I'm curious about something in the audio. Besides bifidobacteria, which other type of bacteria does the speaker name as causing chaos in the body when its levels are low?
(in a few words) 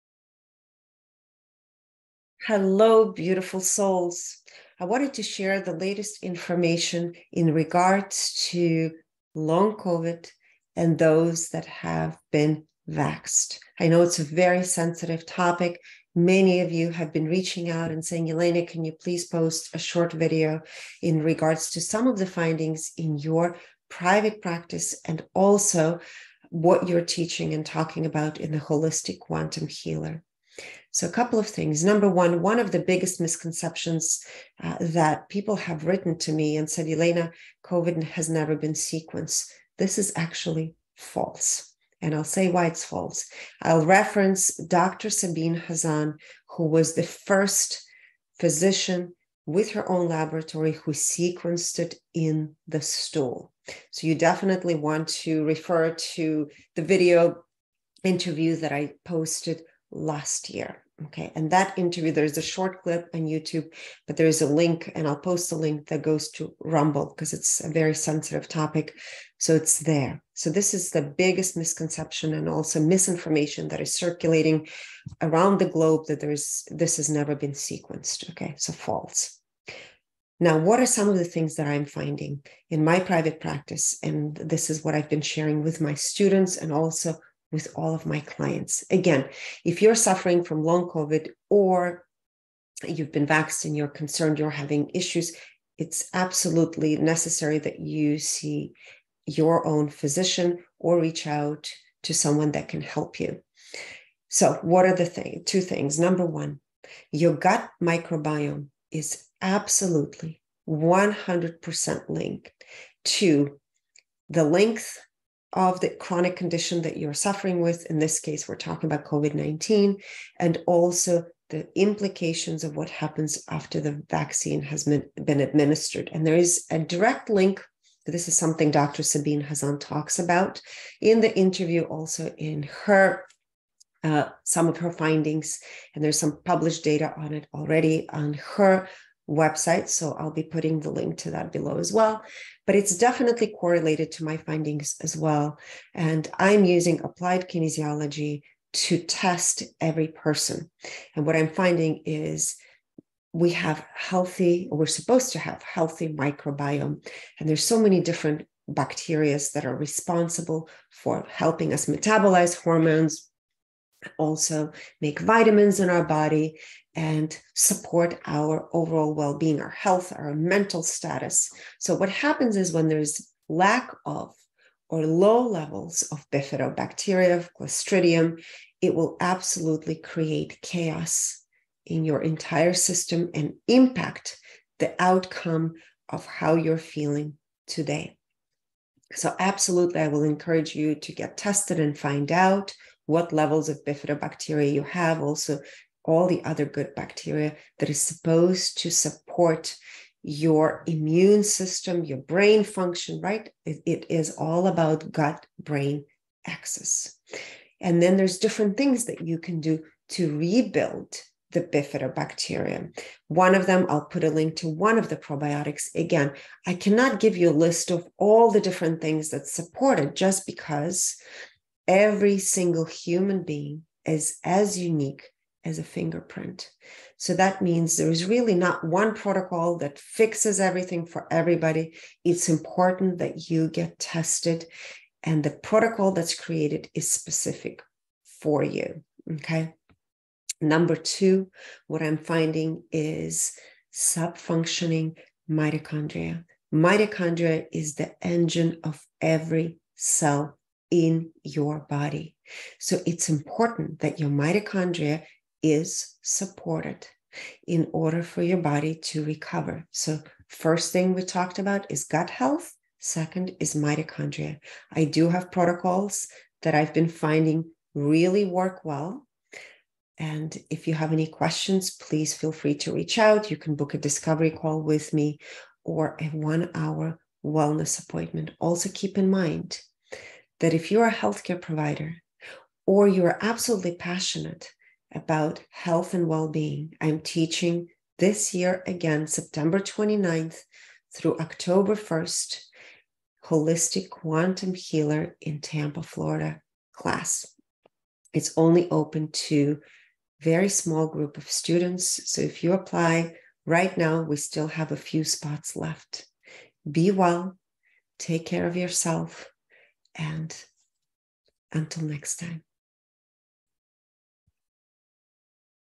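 Clostridium.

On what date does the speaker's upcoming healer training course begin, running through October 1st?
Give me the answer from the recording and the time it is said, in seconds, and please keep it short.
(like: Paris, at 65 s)
September 29, at 289 s.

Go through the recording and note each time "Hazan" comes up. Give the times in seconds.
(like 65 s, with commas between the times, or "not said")
45 s, 129 s.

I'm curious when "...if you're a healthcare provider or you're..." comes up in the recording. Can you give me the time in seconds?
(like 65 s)
280 s.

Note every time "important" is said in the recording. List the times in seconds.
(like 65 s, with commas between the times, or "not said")
232 s, 253 s.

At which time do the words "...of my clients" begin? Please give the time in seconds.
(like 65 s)
87 s.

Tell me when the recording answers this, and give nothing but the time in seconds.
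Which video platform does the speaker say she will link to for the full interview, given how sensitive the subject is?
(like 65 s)
66 s.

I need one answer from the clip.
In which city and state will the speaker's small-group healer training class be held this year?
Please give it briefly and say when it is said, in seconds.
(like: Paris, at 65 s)
Tampa, Florida, at 295 s.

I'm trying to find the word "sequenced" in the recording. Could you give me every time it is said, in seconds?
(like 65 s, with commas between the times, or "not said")
38 s, 50 s, 77 s.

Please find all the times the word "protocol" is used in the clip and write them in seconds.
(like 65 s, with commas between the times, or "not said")
229 s, 235 s, 265 s.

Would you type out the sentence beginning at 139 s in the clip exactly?
So I'll be putting the link to that below as well.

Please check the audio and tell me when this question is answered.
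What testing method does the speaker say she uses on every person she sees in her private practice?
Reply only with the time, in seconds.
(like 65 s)
147 s.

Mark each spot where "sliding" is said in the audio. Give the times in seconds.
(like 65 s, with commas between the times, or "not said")
not said.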